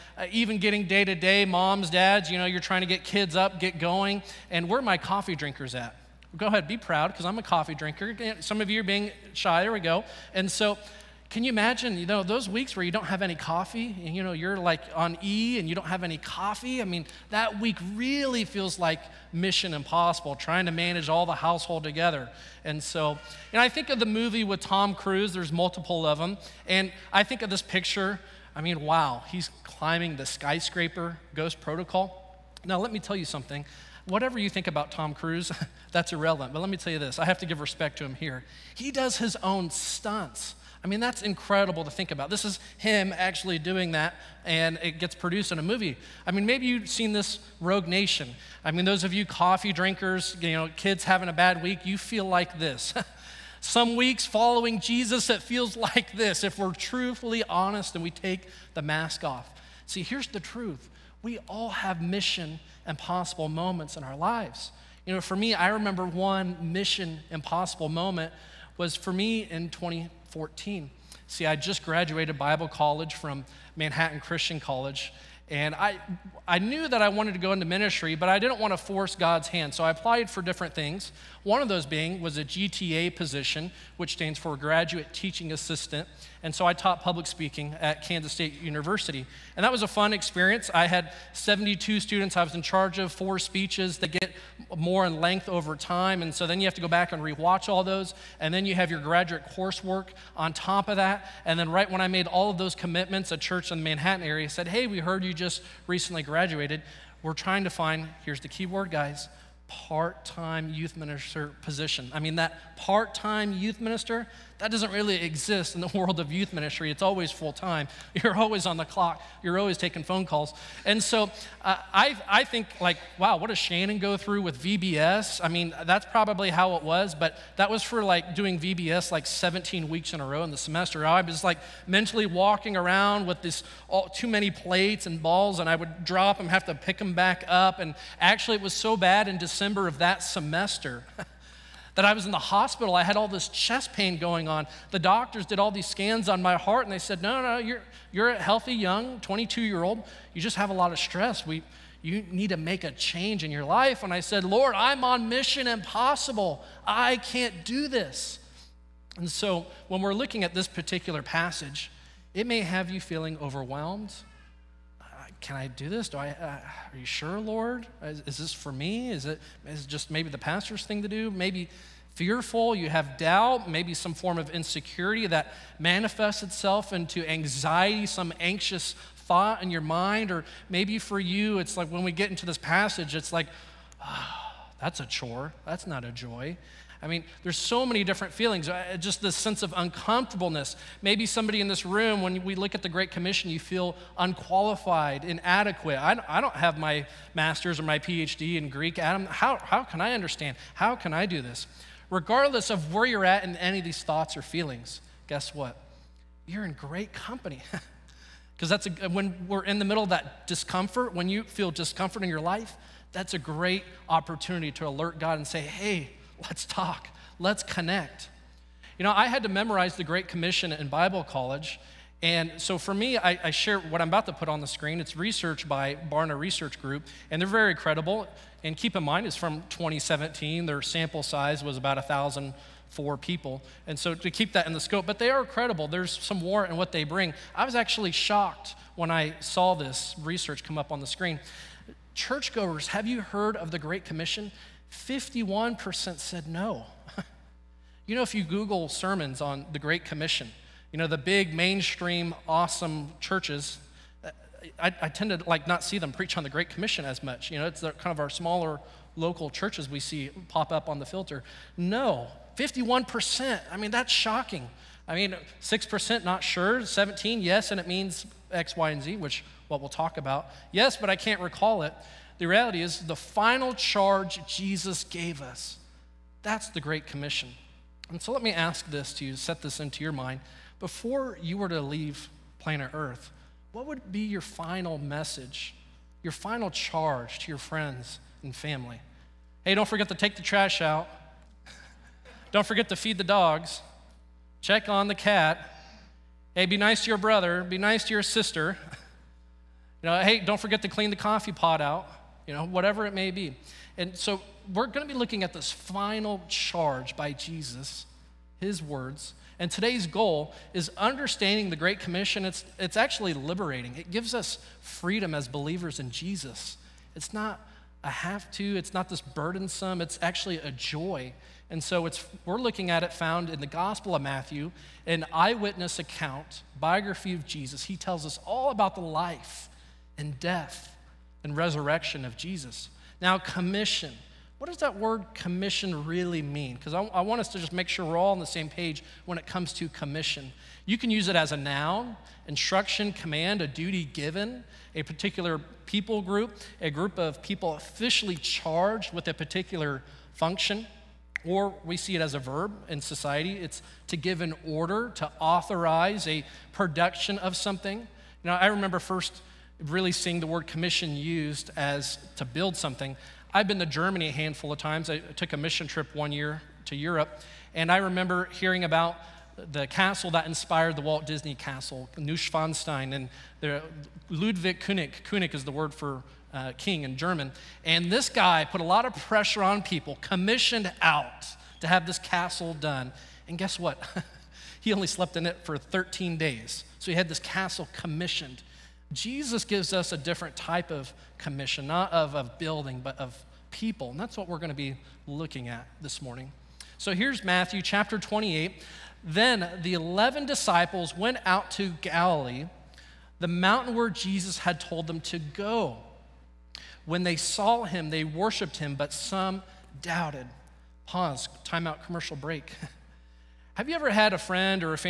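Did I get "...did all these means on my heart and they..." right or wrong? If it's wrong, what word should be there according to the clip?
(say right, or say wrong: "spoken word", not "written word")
wrong: "scans", not "means".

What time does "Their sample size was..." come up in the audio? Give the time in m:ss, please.
3:50.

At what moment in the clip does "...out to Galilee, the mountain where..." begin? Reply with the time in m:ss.
6:41.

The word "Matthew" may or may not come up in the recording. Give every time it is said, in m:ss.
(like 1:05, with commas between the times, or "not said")
5:24, 6:37.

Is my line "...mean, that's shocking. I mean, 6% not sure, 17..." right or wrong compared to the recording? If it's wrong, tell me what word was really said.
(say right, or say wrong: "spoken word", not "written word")
right.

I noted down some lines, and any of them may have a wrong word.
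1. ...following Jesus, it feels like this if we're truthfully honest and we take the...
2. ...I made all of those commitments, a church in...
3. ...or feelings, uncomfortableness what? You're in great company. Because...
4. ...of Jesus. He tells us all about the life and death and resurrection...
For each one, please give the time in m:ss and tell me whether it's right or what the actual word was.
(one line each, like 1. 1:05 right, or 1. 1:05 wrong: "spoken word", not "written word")
1. 0:54 right
2. 1:41 right
3. 3:24 wrong: "guess", not "uncomfortableness"
4. 5:27 right.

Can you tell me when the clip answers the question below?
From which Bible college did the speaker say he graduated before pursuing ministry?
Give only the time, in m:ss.
1:13.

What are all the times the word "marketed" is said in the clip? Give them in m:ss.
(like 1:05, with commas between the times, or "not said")
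not said.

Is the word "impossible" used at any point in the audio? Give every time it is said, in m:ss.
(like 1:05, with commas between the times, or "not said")
0:19, 1:02, 1:07, 2:35.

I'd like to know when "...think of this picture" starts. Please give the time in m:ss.
0:27.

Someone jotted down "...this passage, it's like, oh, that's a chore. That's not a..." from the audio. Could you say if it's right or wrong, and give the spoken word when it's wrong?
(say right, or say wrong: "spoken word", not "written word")
right.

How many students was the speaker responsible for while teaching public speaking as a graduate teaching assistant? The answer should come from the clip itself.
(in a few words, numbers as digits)
72.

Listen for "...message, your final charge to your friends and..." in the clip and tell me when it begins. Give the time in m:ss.
4:44.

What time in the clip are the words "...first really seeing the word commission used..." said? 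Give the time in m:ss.
5:58.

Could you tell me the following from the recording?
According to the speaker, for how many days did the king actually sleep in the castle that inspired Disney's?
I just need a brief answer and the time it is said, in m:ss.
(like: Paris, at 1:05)
13, at 6:25.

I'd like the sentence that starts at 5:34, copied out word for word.
What does that word commission really mean?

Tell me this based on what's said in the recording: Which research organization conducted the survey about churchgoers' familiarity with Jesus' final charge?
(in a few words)
Barna Research Group.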